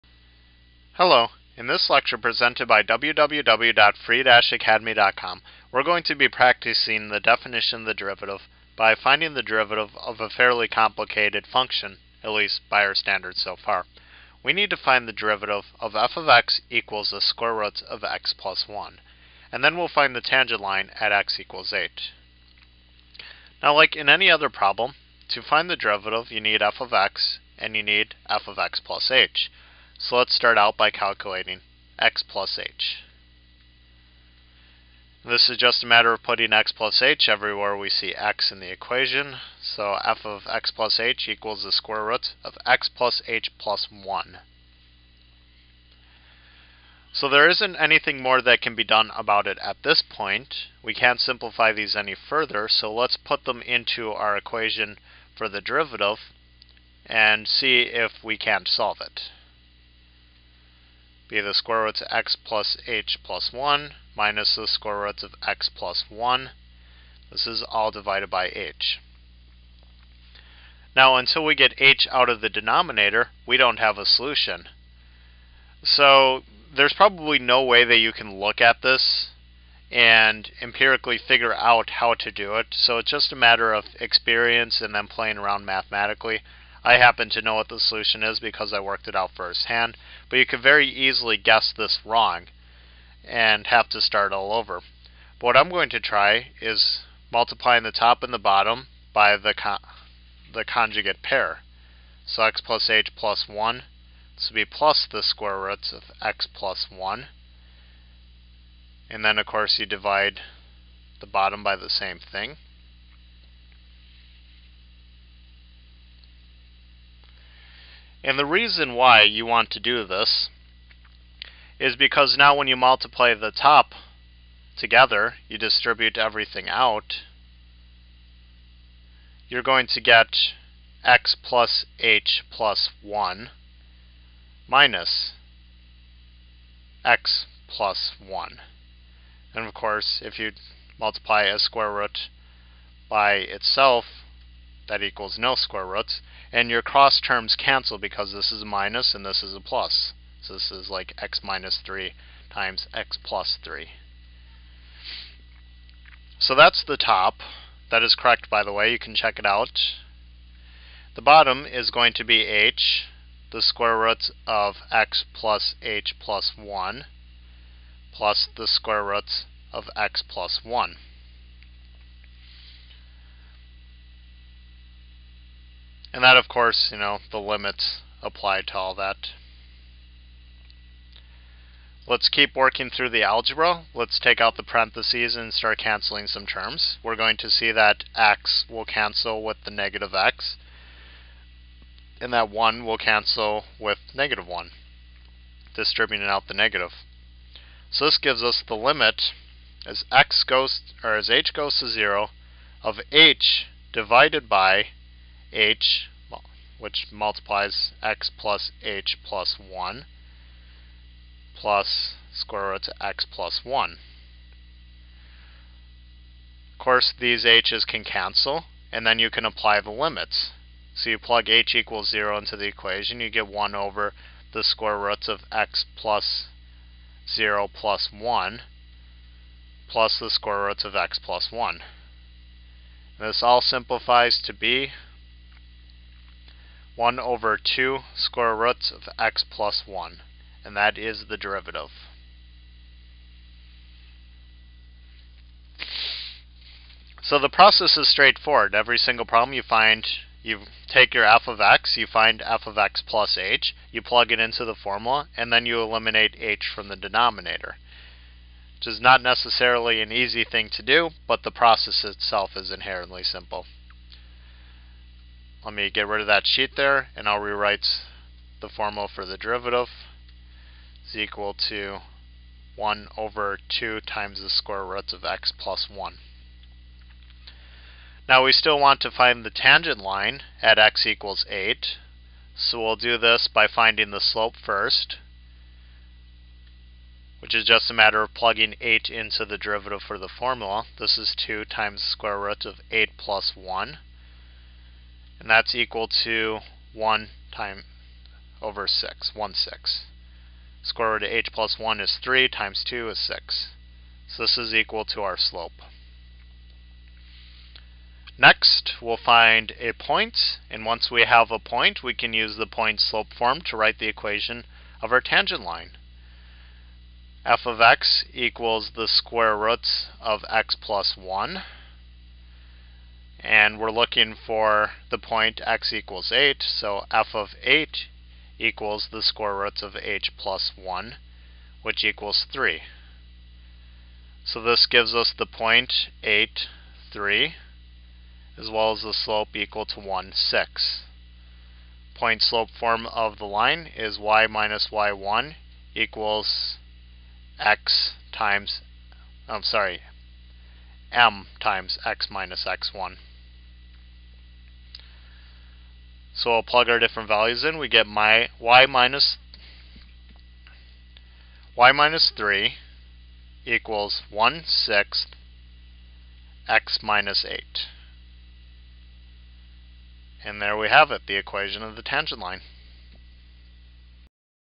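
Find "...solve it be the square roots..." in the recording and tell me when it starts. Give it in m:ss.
0:58.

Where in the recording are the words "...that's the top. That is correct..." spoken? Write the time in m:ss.
2:36.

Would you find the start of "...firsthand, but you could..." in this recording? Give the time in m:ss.
1:29.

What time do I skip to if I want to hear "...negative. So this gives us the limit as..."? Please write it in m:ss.
3:16.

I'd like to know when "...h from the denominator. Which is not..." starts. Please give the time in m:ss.
4:16.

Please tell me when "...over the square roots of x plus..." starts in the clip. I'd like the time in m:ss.
3:43.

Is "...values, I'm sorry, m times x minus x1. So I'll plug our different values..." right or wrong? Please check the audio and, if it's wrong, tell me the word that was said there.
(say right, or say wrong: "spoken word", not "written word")
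wrong: "times", not "values".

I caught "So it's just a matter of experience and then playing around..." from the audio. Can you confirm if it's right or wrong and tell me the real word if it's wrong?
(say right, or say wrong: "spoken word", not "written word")
right.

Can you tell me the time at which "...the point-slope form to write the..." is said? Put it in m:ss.
5:12.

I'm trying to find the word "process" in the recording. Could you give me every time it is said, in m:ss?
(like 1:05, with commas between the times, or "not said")
4:07, 4:21.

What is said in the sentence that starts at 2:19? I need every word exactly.
And of course, if you multiply a square root by itself, that equals no square roots.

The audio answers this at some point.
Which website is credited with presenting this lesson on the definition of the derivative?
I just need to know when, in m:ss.
0:02.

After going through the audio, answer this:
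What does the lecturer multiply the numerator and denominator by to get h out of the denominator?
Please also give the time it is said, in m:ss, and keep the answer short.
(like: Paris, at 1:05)
the conjugate pair, at 1:40.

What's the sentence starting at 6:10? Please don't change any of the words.
And there we have it, the equation of the tangent line.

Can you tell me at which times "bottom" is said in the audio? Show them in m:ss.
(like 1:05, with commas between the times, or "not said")
1:38, 1:51, 2:41.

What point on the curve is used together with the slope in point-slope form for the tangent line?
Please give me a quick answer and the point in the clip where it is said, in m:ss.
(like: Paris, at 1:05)
(8, 3), at 5:36.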